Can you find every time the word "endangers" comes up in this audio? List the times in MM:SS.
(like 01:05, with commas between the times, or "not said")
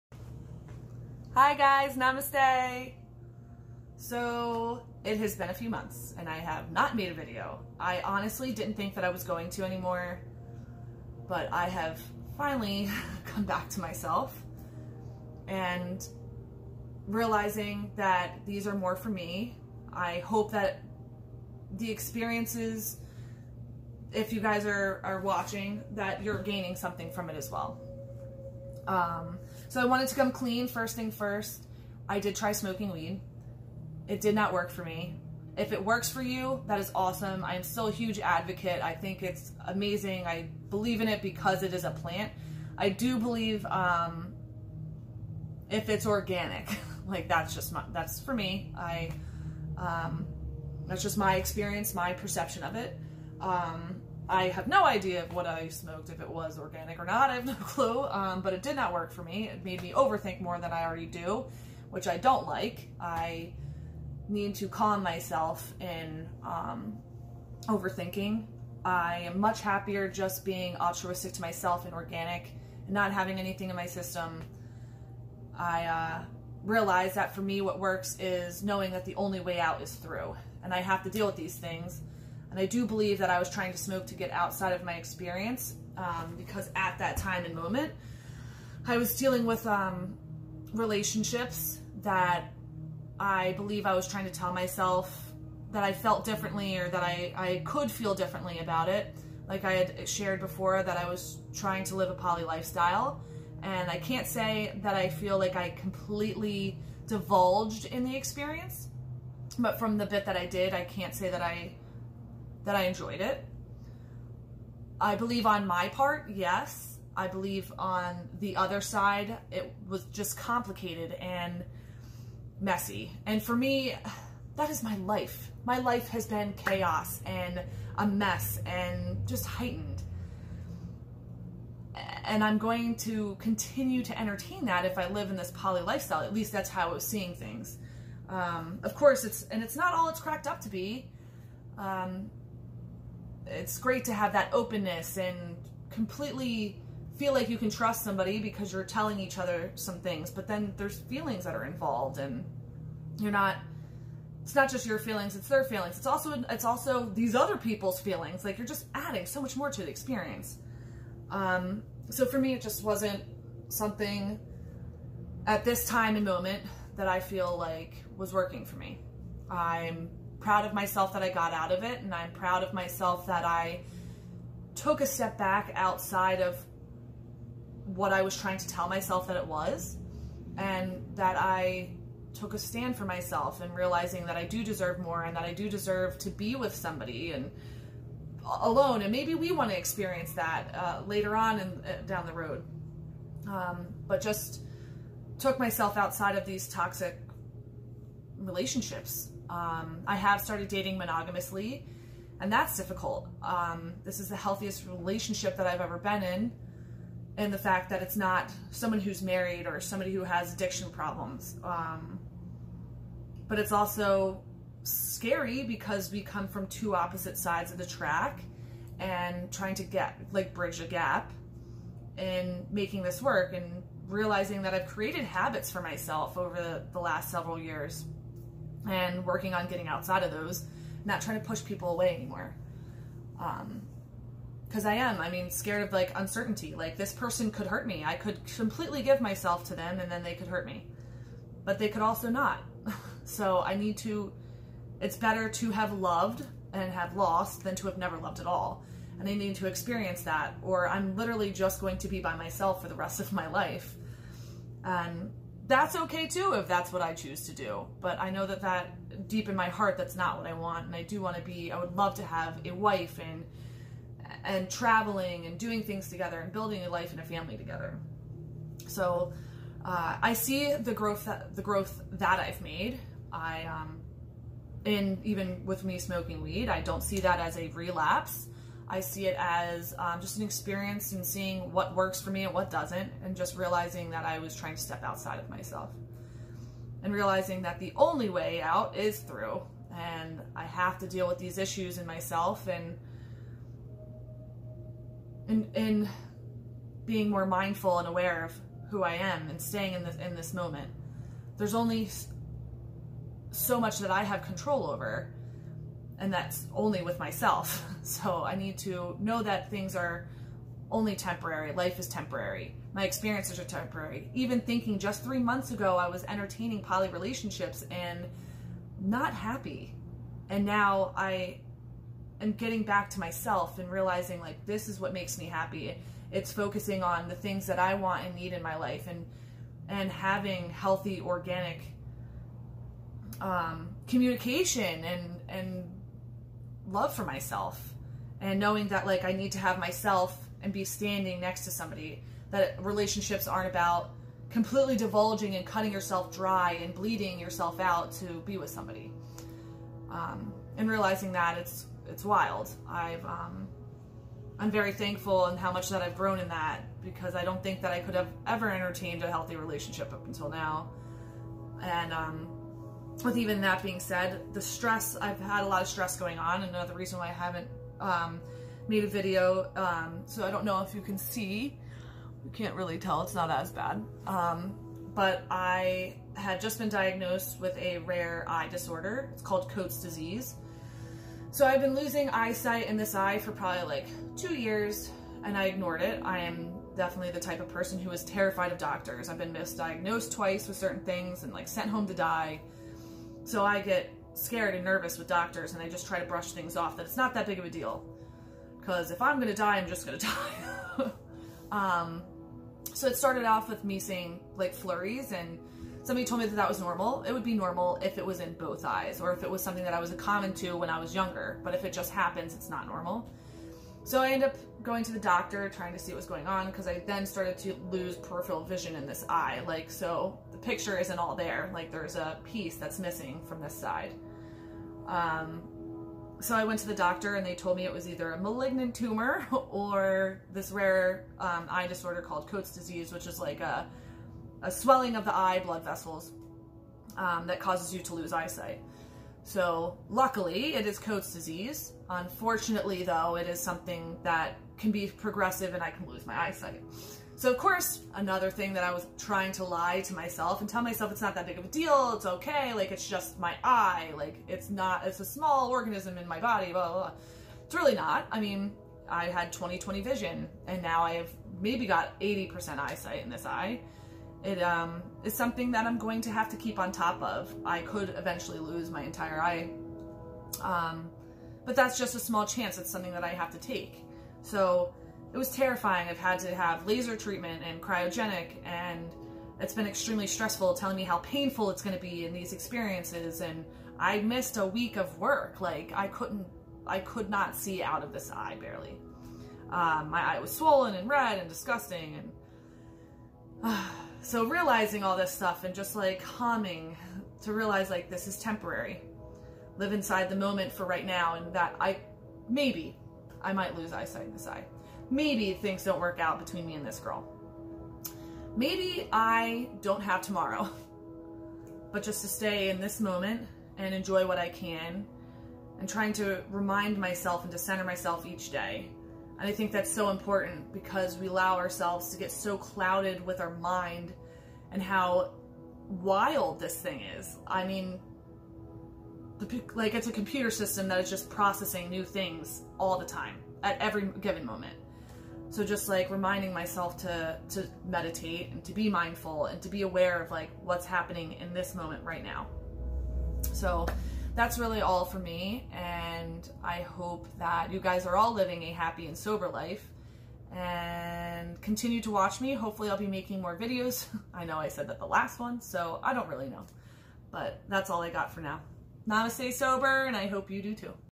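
not said.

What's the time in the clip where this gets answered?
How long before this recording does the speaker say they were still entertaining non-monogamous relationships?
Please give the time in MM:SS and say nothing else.
05:15.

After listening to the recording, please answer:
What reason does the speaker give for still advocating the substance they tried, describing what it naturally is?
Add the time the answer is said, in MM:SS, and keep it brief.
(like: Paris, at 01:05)
it is a plant, at 00:41.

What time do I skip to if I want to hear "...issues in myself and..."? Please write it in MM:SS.
04:51.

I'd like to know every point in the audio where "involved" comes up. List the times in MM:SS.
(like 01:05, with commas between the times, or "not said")
02:31.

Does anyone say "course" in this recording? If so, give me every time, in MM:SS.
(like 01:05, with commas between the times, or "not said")
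02:18, 07:27.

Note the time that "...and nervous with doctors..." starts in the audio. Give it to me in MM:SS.
06:34.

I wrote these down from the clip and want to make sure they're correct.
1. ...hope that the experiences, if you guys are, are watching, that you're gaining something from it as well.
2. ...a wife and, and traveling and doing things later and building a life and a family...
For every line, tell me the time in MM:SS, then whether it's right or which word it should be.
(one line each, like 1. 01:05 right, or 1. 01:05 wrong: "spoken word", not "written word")
1. 00:20 right
2. 04:22 wrong: "together", not "later".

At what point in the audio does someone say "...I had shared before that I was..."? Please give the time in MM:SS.
01:39.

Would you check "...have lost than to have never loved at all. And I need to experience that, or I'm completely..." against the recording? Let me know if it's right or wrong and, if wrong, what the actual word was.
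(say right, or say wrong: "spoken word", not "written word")
wrong: "literally", not "completely".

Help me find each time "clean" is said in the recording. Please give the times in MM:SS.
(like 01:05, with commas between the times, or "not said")
00:30.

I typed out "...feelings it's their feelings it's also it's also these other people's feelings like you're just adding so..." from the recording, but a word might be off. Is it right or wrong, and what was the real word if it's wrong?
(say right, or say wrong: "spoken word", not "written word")
right.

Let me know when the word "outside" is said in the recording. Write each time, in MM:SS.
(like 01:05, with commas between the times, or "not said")
01:24, 02:55, 03:15, 03:49, 04:45.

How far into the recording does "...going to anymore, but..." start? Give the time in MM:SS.
00:09.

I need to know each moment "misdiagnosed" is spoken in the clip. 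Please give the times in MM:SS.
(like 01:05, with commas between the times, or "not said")
06:29.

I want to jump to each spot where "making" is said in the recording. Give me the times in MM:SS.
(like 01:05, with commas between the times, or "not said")
03:42, 09:13.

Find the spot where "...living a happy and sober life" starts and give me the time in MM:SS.
09:08.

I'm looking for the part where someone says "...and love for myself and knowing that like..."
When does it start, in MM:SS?
05:35.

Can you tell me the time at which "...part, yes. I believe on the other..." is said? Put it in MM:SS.
01:55.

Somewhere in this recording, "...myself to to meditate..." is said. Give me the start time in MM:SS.
08:56.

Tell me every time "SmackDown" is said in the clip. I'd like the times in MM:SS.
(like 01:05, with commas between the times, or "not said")
not said.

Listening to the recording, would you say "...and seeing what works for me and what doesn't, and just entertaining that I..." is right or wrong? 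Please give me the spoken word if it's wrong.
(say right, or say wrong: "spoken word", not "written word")
wrong: "realizing", not "entertaining".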